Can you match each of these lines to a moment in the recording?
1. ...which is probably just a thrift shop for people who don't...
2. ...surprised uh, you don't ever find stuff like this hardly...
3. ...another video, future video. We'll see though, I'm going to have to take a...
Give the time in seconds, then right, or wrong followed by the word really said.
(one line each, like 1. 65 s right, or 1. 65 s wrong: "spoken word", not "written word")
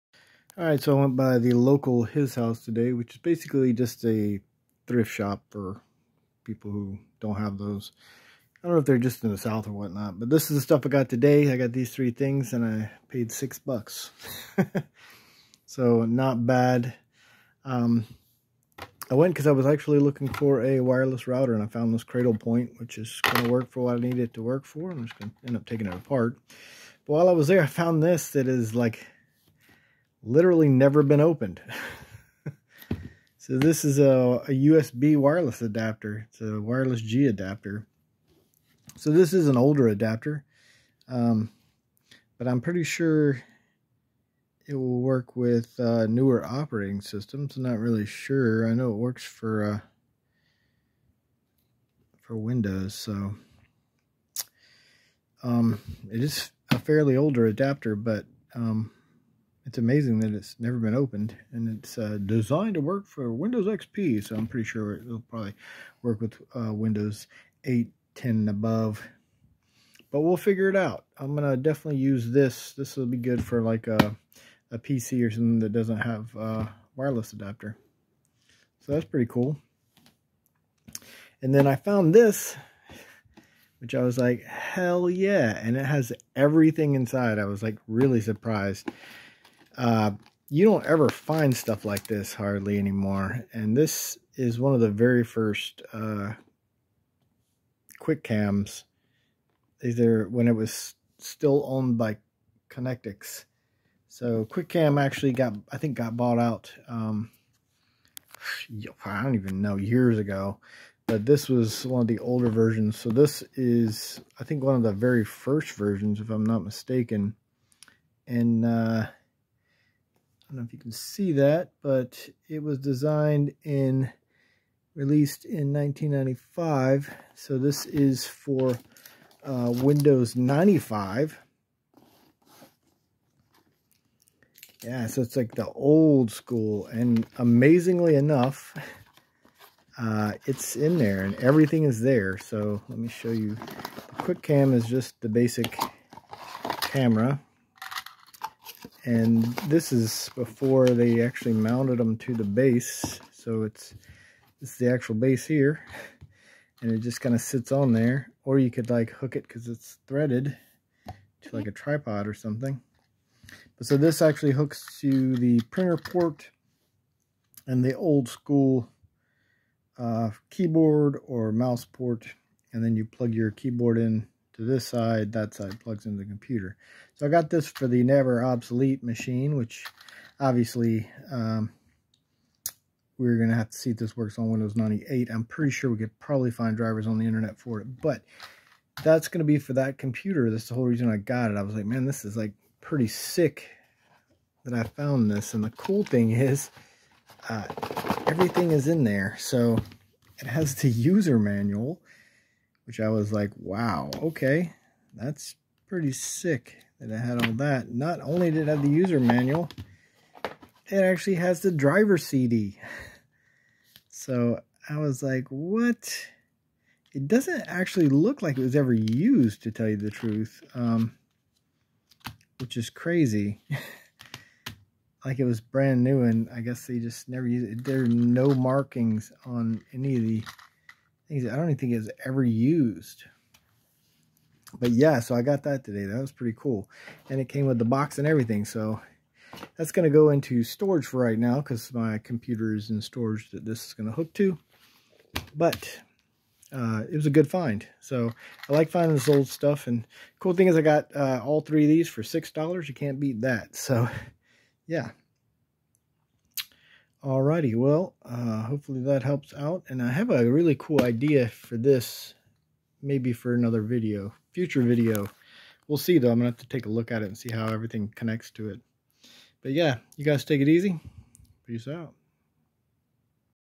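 1. 2 s wrong: "basically", not "probably"
2. 88 s right
3. 263 s right.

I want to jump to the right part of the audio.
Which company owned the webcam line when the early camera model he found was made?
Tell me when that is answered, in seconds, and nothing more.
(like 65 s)
102 s.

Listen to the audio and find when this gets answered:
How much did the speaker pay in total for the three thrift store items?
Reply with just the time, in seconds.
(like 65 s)
252 s.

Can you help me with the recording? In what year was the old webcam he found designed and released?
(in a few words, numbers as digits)
1995.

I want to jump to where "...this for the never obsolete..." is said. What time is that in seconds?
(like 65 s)
177 s.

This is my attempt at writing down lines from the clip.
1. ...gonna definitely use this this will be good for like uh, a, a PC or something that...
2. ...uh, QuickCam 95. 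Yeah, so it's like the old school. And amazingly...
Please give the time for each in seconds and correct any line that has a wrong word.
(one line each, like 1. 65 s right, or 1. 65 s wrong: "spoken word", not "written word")
1. 71 s right
2. 129 s wrong: "Windows", not "QuickCam".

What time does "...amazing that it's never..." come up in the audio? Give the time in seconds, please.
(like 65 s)
59 s.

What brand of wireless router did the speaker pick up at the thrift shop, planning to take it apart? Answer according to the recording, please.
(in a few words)
Cradlepoint.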